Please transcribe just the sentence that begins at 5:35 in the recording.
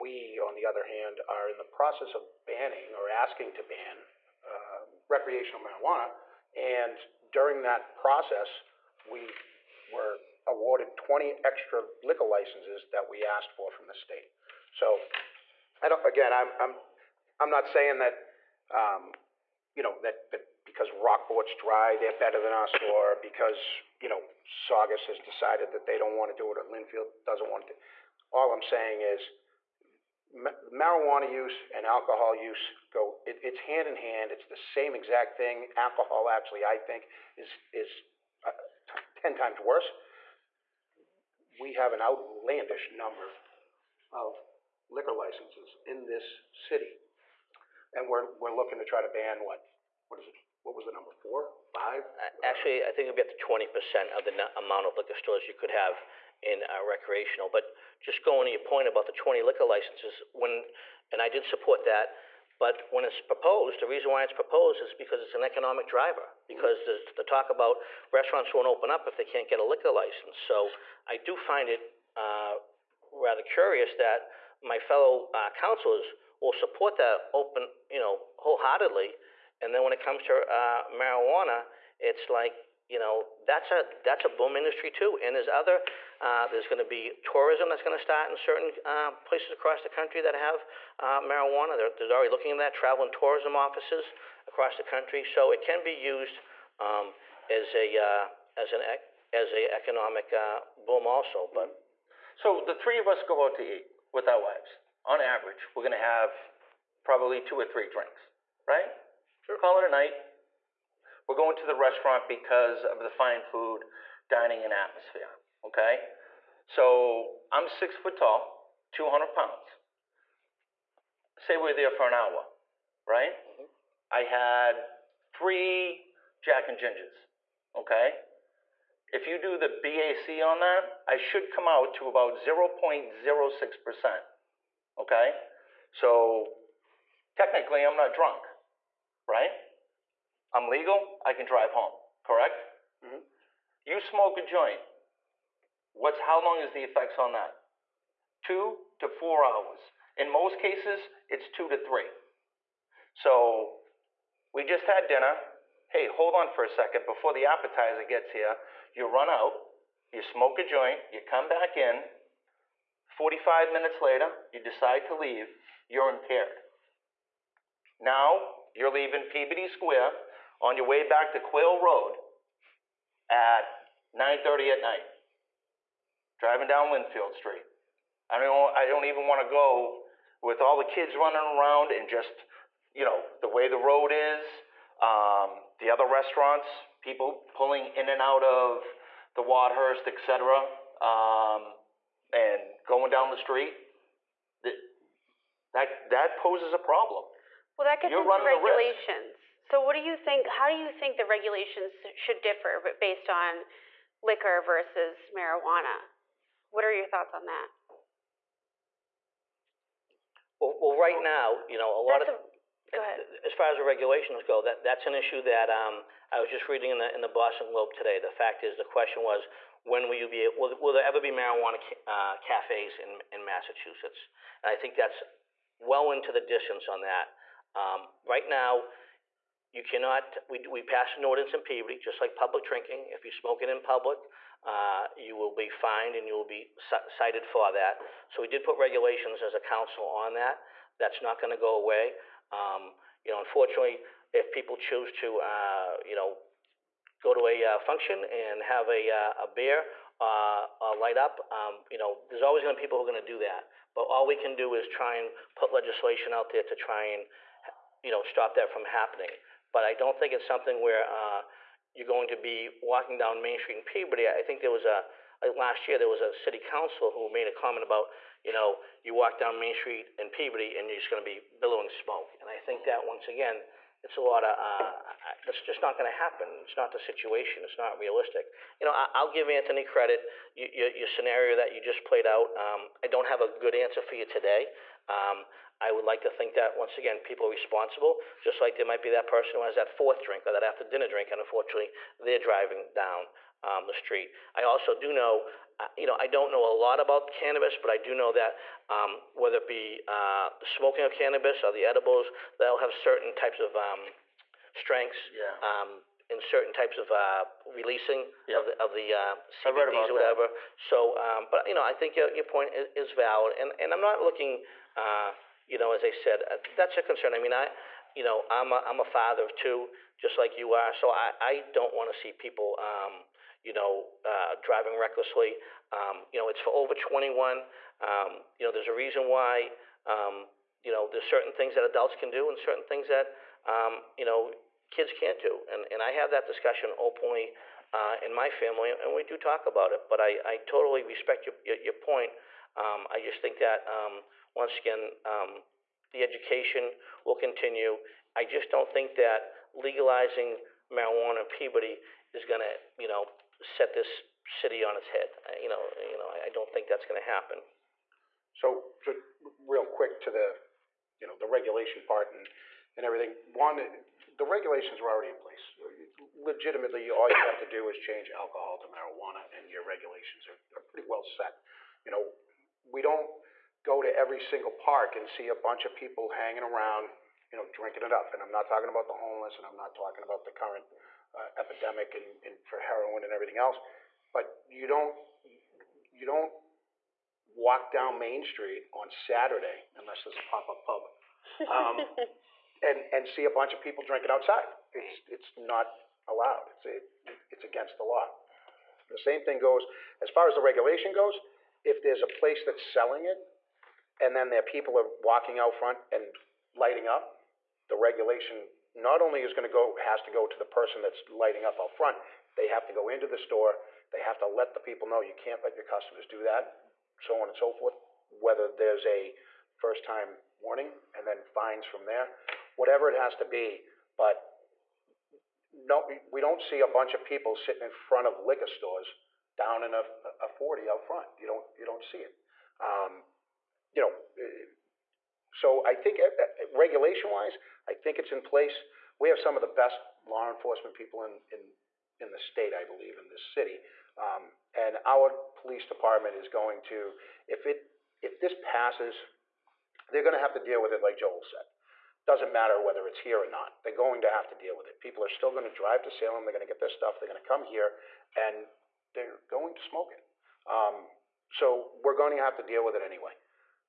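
And, and I have that discussion openly uh, in my family, and we do talk about it.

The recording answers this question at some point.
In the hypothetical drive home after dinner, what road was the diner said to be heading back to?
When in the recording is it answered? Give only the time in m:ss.
2:51.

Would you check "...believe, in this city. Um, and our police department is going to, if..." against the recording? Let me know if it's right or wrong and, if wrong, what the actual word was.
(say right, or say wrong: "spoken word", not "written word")
right.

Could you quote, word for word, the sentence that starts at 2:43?
45 minutes later, you decide to leave, you're impaired.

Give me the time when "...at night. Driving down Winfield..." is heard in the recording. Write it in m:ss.
2:54.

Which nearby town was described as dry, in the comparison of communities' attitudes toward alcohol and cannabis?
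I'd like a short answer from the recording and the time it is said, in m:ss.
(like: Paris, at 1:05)
Rockport, at 0:20.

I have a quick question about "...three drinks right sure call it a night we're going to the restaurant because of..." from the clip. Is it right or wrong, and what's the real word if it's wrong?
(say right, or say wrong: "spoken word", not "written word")
right.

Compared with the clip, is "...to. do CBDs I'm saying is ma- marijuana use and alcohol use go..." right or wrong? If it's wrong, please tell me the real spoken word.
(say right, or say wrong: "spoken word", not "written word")
wrong: "All", not "CBDs".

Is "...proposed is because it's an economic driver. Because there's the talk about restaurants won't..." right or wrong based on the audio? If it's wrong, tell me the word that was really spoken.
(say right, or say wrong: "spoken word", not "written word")
right.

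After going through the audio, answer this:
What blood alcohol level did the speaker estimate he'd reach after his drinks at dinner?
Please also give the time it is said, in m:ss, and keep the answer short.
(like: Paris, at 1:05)
0.06%, at 2:12.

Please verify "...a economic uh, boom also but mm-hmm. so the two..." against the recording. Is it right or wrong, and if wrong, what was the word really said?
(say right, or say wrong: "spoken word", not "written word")
wrong: "three", not "two".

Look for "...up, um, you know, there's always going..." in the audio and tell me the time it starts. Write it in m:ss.
4:11.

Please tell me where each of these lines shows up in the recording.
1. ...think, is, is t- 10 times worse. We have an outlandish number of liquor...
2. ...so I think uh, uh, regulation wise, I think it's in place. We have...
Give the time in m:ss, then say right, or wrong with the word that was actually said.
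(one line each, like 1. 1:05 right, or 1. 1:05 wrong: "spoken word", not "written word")
1. 0:36 right
2. 7:15 right.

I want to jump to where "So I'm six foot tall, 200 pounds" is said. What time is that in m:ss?
1:56.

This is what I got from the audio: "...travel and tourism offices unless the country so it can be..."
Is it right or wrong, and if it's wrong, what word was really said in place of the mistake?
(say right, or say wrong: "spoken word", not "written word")
wrong: "across", not "unless".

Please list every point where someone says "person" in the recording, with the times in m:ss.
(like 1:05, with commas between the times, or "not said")
4:49, 6:50.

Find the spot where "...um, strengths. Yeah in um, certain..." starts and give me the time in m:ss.
5:03.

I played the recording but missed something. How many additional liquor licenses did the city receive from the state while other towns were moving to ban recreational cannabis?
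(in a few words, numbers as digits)
20.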